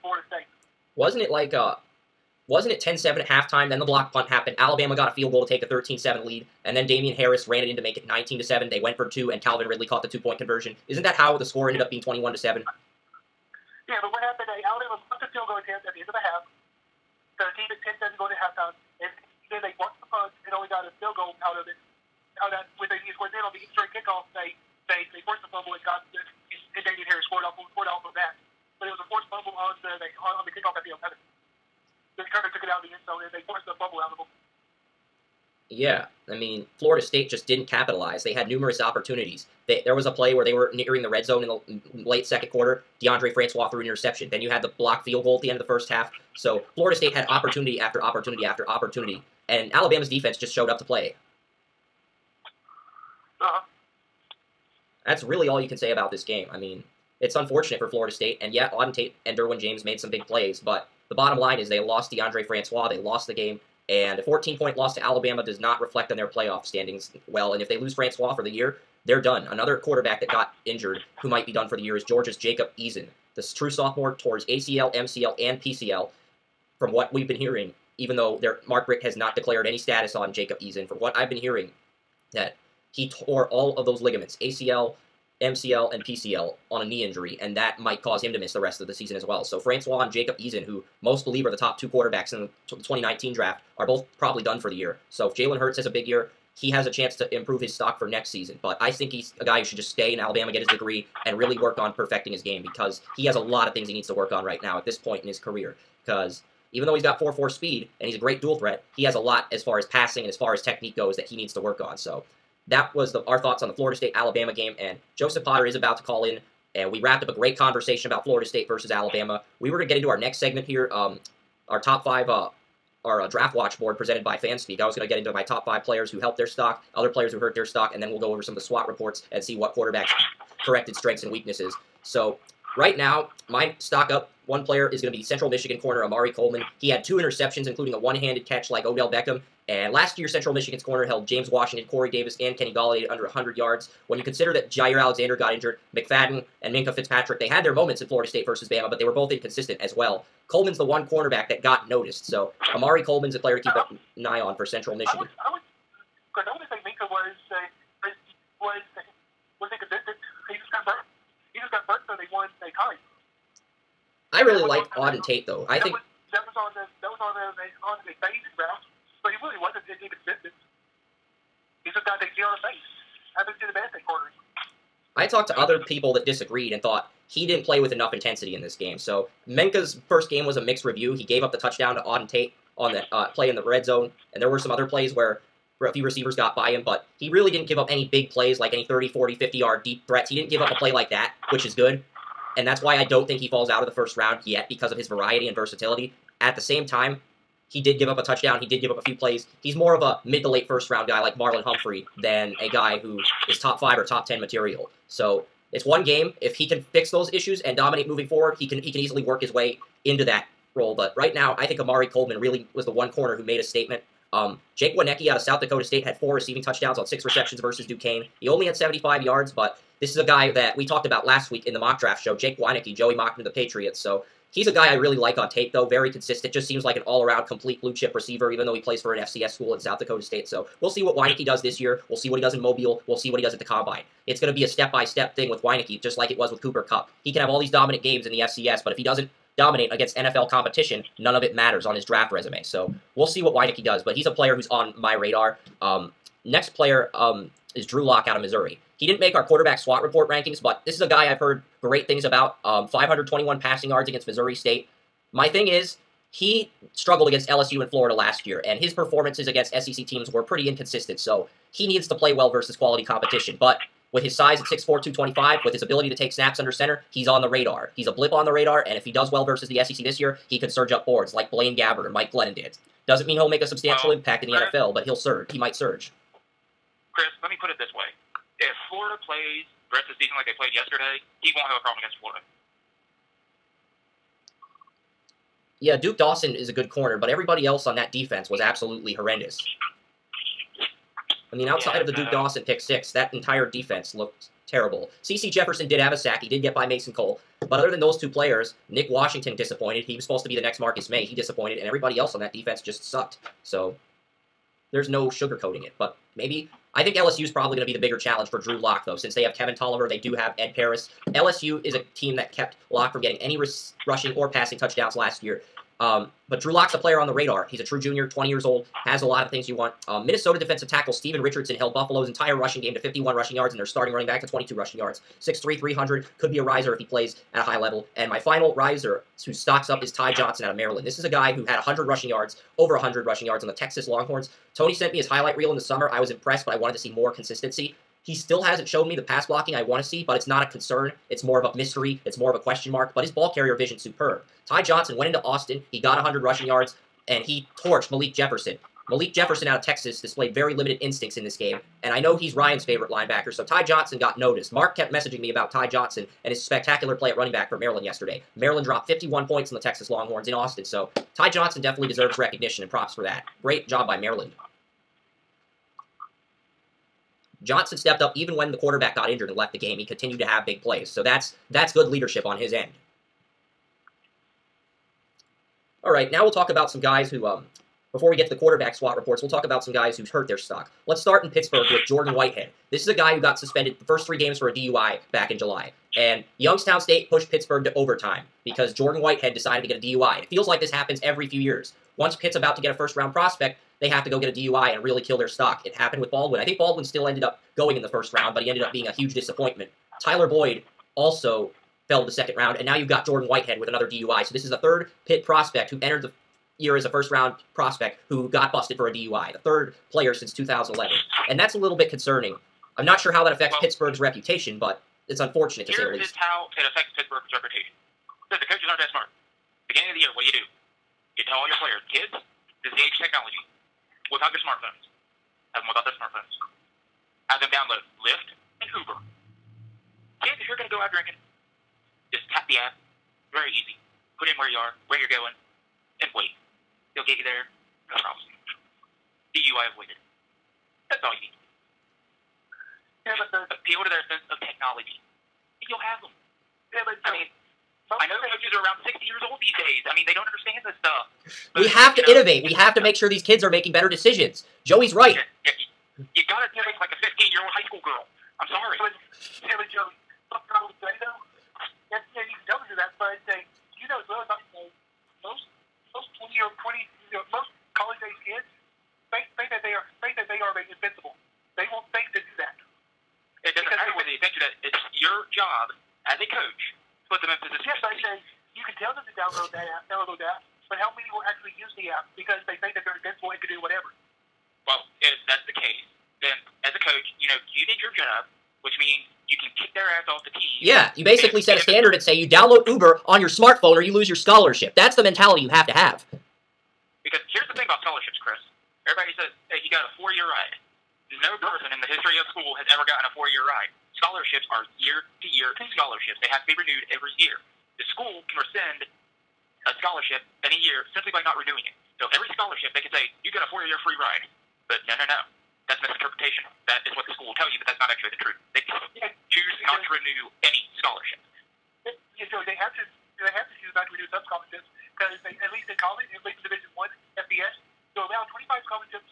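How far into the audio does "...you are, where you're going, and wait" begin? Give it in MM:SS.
07:14.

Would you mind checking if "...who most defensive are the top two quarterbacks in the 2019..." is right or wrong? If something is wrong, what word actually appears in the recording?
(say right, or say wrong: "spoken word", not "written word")
wrong: "believe", not "defensive".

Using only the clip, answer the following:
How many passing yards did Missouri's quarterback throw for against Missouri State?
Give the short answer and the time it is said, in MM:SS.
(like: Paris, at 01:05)
521, at 04:12.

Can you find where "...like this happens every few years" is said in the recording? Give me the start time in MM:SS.
06:30.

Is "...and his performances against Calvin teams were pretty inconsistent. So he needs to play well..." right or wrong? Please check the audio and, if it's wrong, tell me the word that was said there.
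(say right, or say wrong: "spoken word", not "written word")
wrong: "SEC", not "Calvin".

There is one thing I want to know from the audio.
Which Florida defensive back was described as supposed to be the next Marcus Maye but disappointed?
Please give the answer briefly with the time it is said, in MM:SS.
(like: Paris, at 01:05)
Nick Washington, at 04:58.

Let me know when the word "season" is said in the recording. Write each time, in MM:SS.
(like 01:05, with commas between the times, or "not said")
01:28, 01:38, 04:40.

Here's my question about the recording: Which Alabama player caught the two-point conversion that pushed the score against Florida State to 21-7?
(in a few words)
Calvin Ridley.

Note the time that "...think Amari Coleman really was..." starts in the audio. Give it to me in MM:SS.
03:31.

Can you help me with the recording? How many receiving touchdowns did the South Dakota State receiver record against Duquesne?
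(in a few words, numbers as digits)
4.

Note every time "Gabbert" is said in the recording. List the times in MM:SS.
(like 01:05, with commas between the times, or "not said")
04:31.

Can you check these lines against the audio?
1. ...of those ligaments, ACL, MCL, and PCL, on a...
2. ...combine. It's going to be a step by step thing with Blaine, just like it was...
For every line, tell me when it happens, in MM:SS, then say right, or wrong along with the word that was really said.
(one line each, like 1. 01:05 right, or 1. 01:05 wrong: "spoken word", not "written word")
1. 01:23 right
2. 03:53 wrong: "Wieneke", not "Blaine".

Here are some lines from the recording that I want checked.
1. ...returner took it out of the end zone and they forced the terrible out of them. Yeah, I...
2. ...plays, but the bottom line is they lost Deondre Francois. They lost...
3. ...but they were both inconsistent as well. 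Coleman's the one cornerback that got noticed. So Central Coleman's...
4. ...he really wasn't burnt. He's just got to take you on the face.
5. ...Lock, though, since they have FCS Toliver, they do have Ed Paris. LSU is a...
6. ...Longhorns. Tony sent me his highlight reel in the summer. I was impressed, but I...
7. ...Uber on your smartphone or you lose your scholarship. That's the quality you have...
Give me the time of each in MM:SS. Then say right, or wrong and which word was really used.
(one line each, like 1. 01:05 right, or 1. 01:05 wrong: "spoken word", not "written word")
1. 00:32 wrong: "fumble", not "terrible"
2. 01:00 right
3. 02:28 wrong: "Amari", not "Central"
4. 02:49 wrong: "inconsistent", not "burnt"
5. 05:08 wrong: "Kevin", not "FCS"
6. 05:34 right
7. 08:12 wrong: "mentality", not "quality".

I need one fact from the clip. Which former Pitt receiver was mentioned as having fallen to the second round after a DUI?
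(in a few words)
Tyler Boyd.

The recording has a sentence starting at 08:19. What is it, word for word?
Everybody says, that he got a four-year ride.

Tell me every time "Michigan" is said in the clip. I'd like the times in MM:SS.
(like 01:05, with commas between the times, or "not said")
02:15, 02:20, 02:34.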